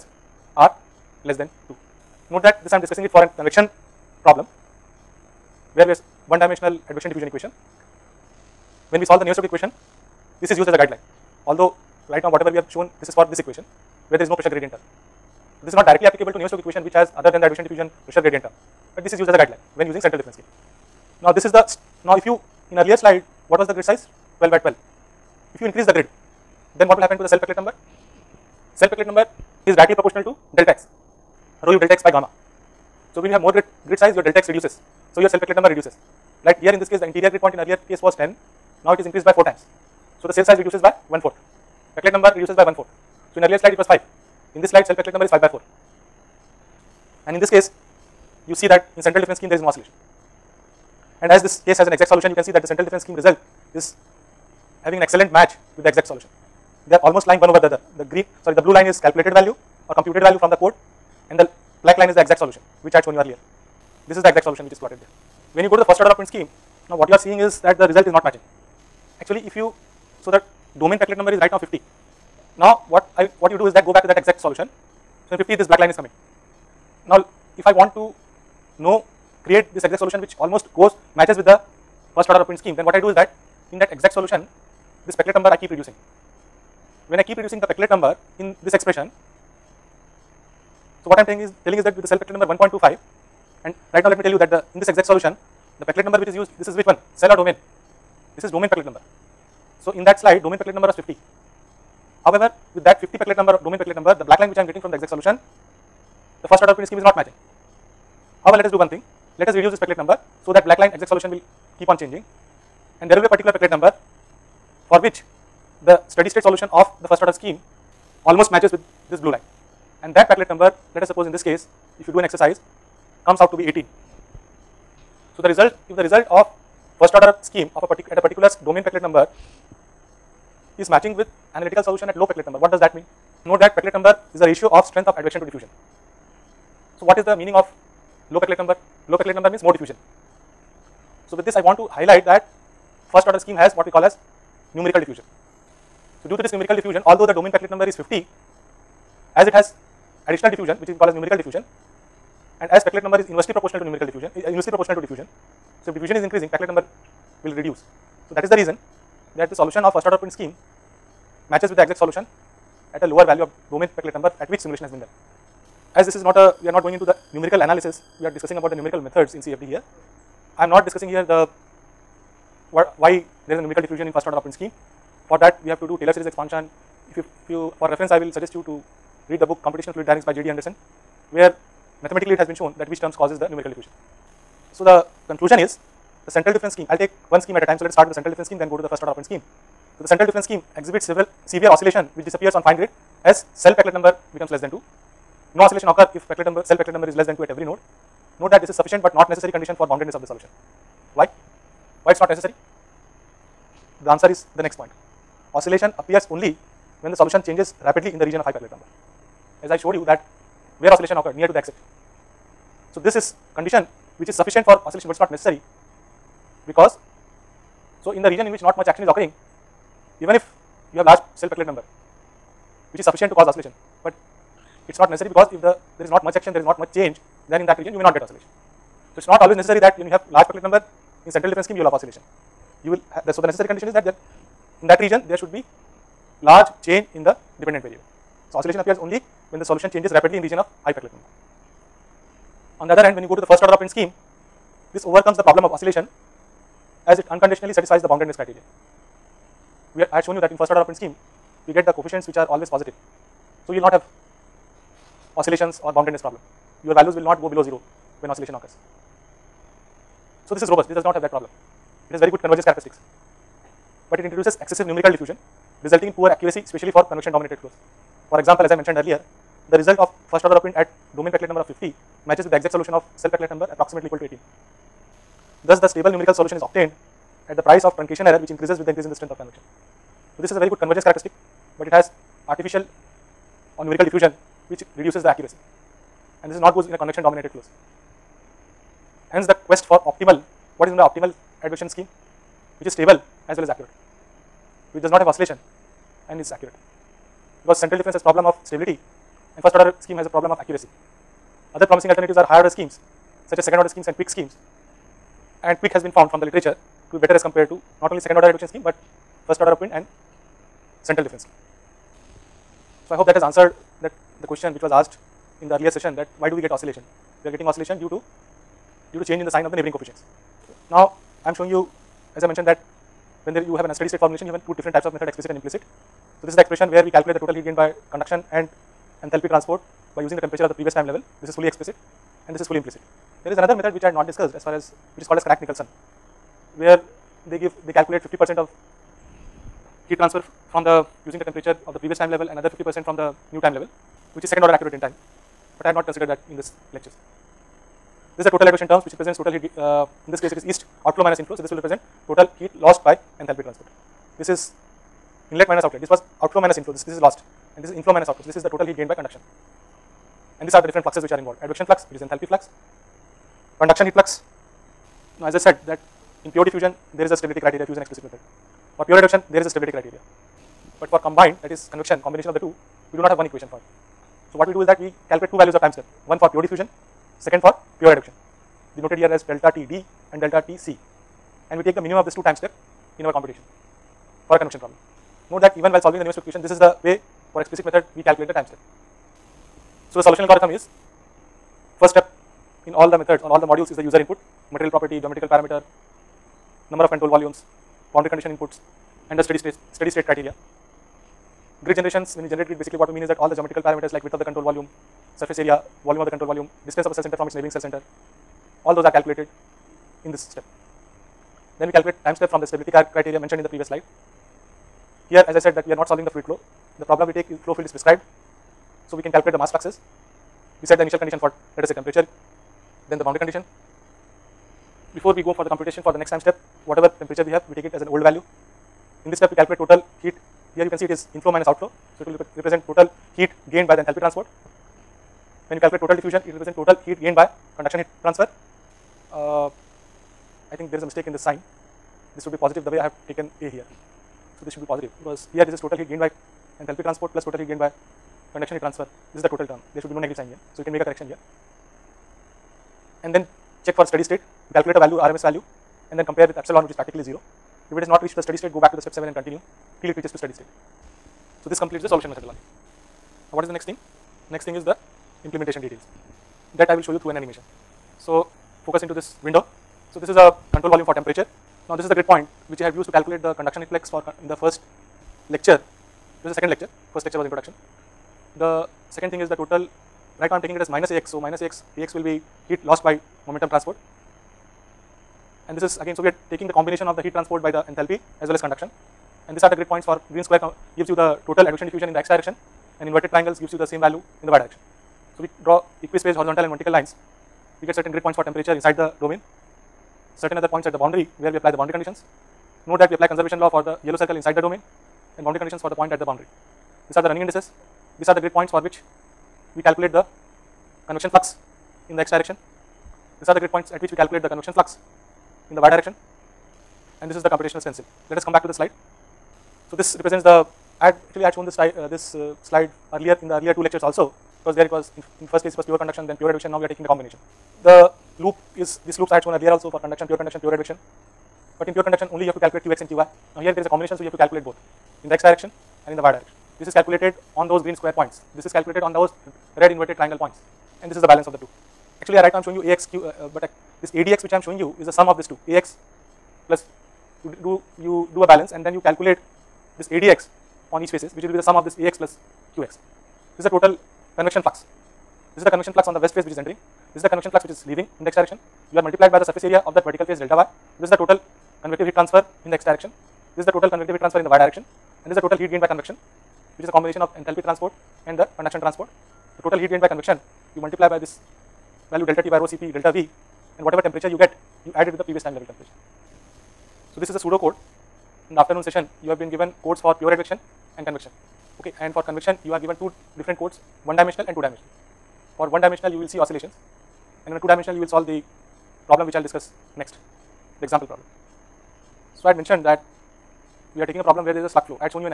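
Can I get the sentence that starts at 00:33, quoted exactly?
So, when you have more grid, grid size, your delta x reduces.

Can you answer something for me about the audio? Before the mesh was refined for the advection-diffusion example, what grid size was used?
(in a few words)
12 by 12.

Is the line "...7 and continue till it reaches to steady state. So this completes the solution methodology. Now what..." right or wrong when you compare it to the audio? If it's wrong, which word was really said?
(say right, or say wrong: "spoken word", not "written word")
right.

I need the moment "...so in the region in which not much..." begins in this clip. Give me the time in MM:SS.
03:38.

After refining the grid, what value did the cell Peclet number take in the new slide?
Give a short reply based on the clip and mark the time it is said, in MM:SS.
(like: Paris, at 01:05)
5/4, at 00:45.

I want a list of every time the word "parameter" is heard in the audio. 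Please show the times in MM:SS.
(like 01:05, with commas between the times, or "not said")
06:35, 06:43.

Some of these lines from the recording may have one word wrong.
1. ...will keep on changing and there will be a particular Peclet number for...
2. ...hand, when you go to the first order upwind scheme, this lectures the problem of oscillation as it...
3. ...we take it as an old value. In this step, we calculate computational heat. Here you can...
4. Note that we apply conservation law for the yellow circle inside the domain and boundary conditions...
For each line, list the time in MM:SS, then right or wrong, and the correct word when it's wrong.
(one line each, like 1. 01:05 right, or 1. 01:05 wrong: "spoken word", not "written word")
1. 01:51 right
2. 04:03 wrong: "overcomes", not "lectures"
3. 07:07 wrong: "total", not "computational"
4. 08:22 right.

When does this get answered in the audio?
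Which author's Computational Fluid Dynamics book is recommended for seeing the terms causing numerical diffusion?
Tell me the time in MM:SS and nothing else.
03:00.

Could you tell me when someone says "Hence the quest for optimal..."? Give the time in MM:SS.
04:49.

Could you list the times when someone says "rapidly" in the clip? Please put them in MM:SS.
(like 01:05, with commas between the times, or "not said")
03:27, 04:00.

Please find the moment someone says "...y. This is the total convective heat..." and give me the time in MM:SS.
09:20.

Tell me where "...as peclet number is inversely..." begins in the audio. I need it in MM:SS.
02:32.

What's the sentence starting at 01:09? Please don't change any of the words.
Actually, if you, so that domain Peclet number is right now 50.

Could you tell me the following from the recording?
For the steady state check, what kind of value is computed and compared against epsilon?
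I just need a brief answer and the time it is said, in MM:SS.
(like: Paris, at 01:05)
RMS value, at 07:35.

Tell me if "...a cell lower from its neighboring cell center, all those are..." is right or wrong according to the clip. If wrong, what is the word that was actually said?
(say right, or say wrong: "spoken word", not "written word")
wrong: "center", not "lower".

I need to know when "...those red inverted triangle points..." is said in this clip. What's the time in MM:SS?
08:59.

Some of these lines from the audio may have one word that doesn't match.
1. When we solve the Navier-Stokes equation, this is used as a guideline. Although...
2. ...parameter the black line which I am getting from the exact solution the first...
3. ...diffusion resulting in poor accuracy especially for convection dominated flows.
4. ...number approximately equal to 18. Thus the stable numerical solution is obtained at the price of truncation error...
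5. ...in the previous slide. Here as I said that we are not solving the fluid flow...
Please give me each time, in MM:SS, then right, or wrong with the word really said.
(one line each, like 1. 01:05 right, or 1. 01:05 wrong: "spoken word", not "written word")
1. 00:08 right
2. 01:43 wrong: "number", not "parameter"
3. 04:25 right
4. 04:33 right
5. 06:53 right.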